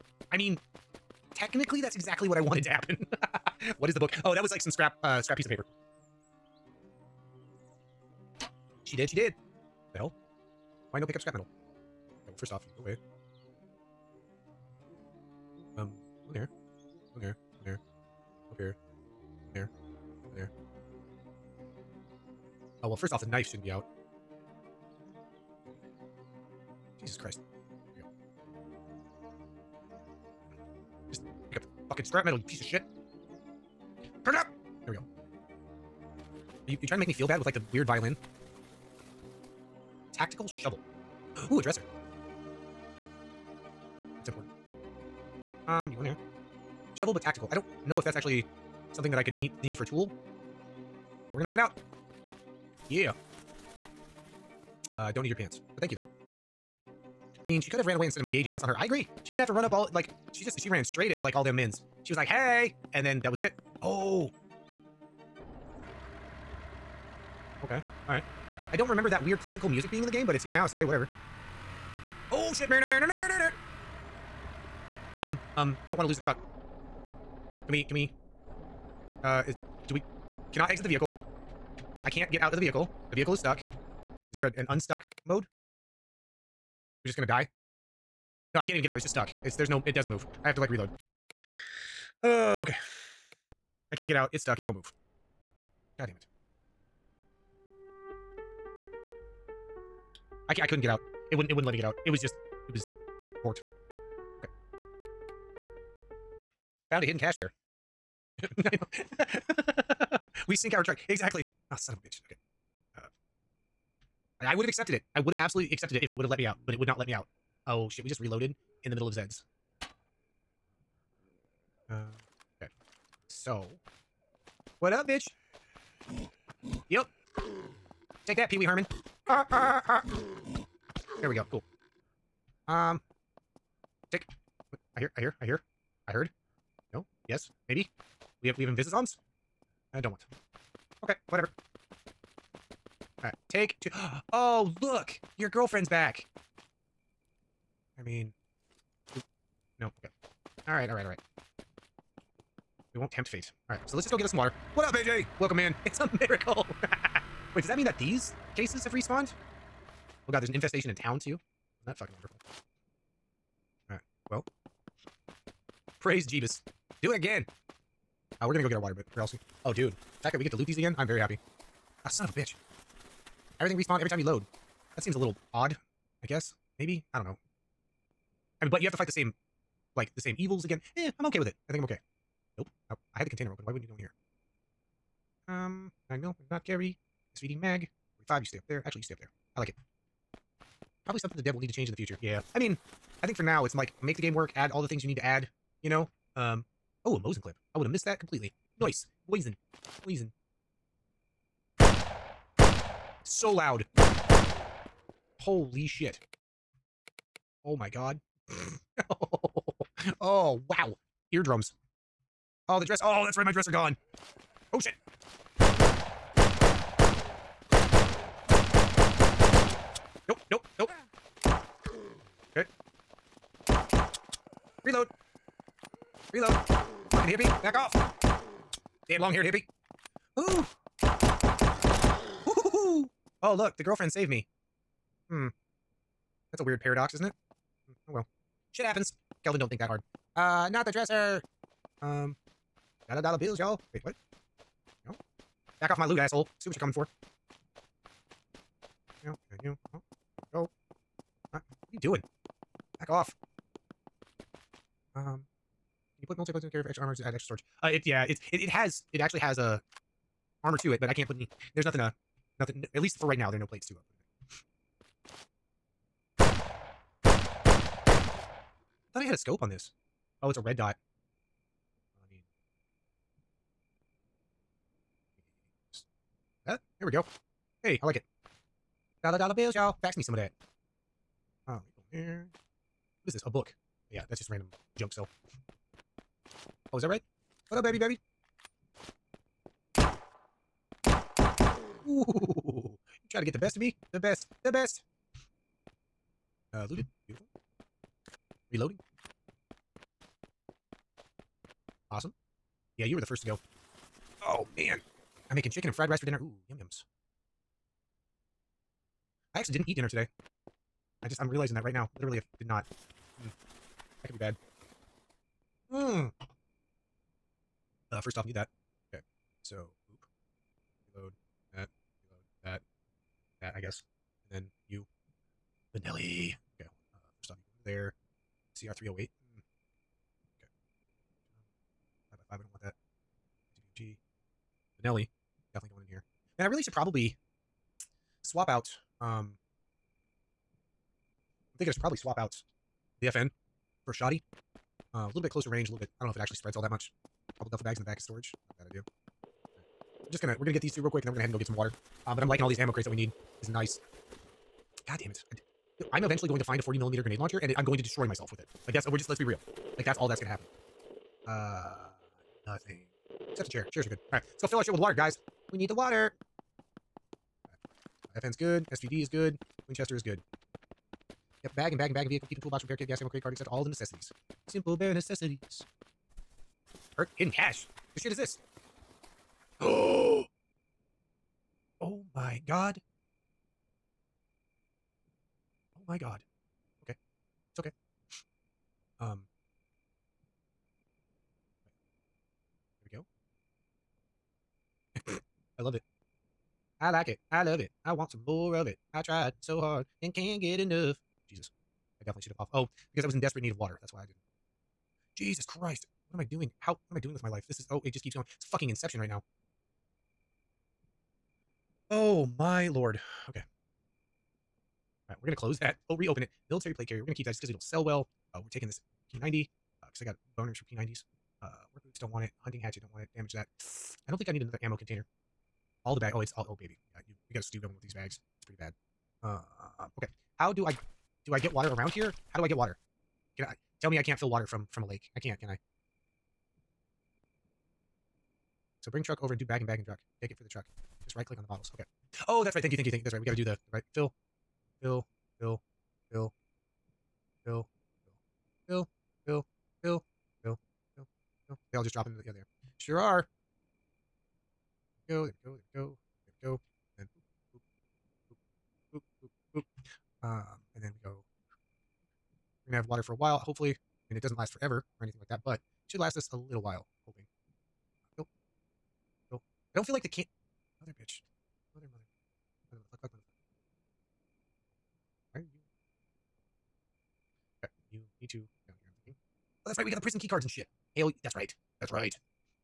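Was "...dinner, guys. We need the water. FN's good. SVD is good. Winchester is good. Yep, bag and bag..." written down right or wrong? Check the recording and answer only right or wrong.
wrong.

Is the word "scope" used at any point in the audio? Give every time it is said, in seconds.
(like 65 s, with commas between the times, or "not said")
269 s.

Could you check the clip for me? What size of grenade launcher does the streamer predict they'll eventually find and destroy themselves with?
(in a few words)
40 millimeter.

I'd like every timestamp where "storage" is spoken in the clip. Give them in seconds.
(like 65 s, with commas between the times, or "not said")
257 s, 348 s.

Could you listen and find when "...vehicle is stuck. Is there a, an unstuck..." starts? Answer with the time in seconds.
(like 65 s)
83 s.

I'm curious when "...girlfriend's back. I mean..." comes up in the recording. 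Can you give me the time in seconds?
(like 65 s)
145 s.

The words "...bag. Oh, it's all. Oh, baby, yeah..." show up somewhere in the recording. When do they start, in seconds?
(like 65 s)
426 s.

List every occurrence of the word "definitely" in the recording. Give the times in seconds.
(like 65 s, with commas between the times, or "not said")
335 s, 402 s.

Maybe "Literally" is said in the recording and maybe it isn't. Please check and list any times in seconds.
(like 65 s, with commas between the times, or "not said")
312 s.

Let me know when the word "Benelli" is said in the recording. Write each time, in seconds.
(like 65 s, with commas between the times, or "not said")
325 s, 335 s.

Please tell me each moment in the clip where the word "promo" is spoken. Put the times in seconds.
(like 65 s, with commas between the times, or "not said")
not said.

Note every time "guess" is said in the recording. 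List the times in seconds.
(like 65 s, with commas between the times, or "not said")
176 s, 323 s.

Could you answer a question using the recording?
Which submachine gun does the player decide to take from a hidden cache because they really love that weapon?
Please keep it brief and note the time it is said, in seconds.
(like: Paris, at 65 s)
P90, at 419 s.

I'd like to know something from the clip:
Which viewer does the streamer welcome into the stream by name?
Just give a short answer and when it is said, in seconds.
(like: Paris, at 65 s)
AJ, at 154 s.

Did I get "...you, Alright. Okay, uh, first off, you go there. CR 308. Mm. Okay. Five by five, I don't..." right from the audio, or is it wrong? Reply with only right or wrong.
wrong.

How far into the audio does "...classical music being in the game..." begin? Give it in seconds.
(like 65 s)
69 s.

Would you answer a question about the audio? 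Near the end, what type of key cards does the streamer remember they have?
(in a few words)
Prison key cards.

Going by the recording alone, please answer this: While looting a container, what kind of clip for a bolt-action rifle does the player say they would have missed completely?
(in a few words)
Mosin clip.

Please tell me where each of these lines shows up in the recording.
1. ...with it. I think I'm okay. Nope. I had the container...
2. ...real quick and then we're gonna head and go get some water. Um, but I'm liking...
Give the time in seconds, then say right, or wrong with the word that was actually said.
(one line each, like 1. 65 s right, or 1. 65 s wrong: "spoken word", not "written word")
1. 181 s right
2. 351 s right.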